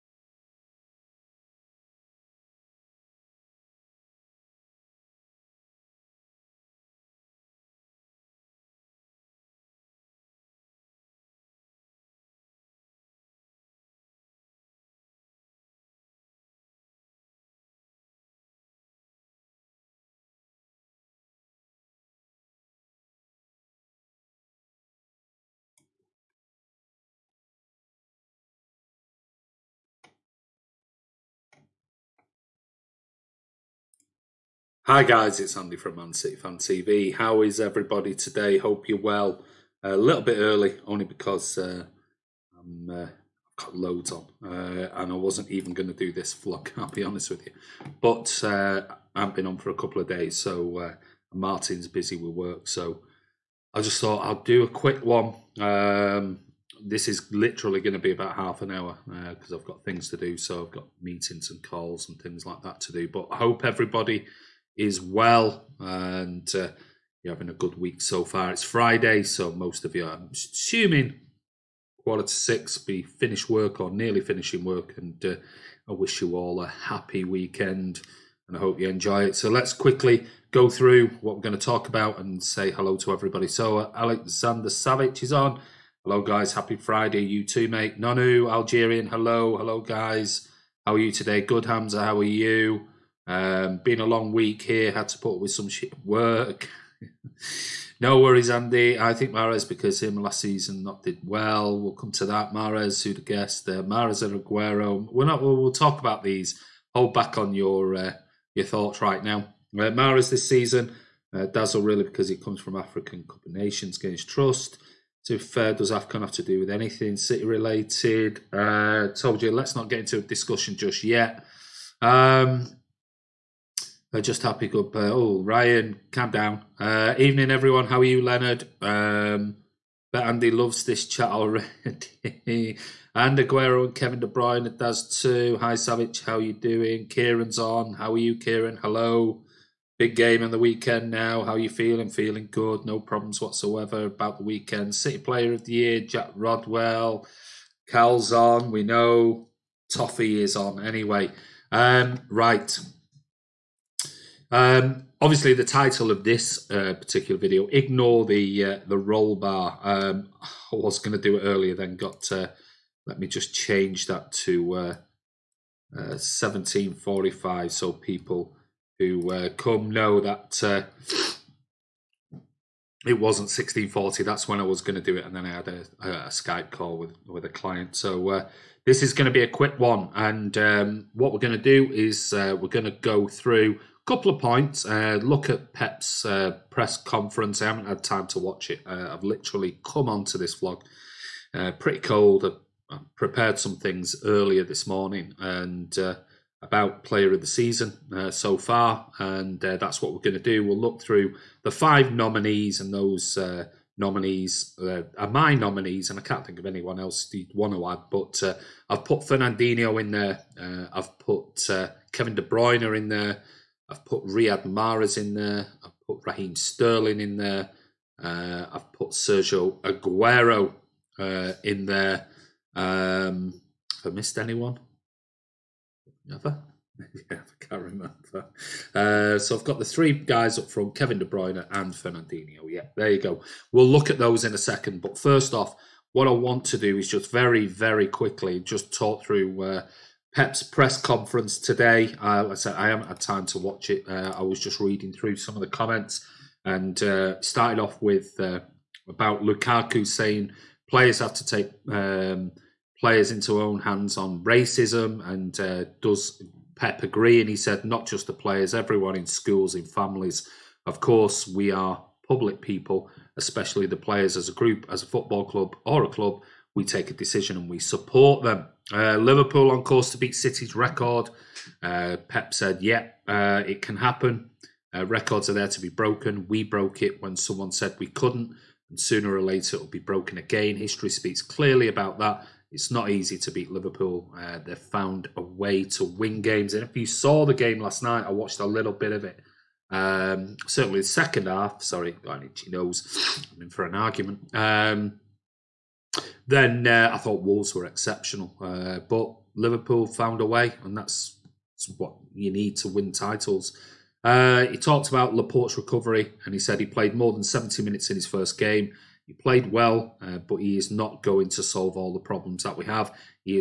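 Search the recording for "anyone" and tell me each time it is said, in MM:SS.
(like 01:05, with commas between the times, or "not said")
03:26, 03:44.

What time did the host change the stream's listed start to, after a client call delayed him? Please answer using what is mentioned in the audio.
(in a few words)
17:45.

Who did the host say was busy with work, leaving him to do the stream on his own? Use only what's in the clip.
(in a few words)
Martin.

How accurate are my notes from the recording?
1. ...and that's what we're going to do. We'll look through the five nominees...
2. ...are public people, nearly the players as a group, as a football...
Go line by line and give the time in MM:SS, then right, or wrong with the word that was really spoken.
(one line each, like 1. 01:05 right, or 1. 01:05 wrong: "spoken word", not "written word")
1. 03:19 right
2. 04:21 wrong: "especially", not "nearly".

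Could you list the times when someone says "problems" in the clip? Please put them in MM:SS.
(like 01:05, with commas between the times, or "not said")
02:22, 05:12.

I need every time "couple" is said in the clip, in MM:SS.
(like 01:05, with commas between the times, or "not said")
00:49, 03:04.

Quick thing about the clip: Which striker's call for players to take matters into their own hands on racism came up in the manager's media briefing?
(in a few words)
Lukaku.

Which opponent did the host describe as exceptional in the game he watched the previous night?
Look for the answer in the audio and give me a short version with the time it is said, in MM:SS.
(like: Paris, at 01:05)
Wolves, at 04:57.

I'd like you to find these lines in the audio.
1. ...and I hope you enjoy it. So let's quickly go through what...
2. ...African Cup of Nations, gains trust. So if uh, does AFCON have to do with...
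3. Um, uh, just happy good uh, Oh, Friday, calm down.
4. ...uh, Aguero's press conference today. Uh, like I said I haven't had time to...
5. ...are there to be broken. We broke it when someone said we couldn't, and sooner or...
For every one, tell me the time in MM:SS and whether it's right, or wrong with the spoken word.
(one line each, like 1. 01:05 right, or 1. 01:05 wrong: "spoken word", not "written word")
1. 01:18 right
2. 01:52 right
3. 02:02 wrong: "Ryan", not "Friday"
4. 03:59 wrong: "Pep", not "Aguero"
5. 04:35 right.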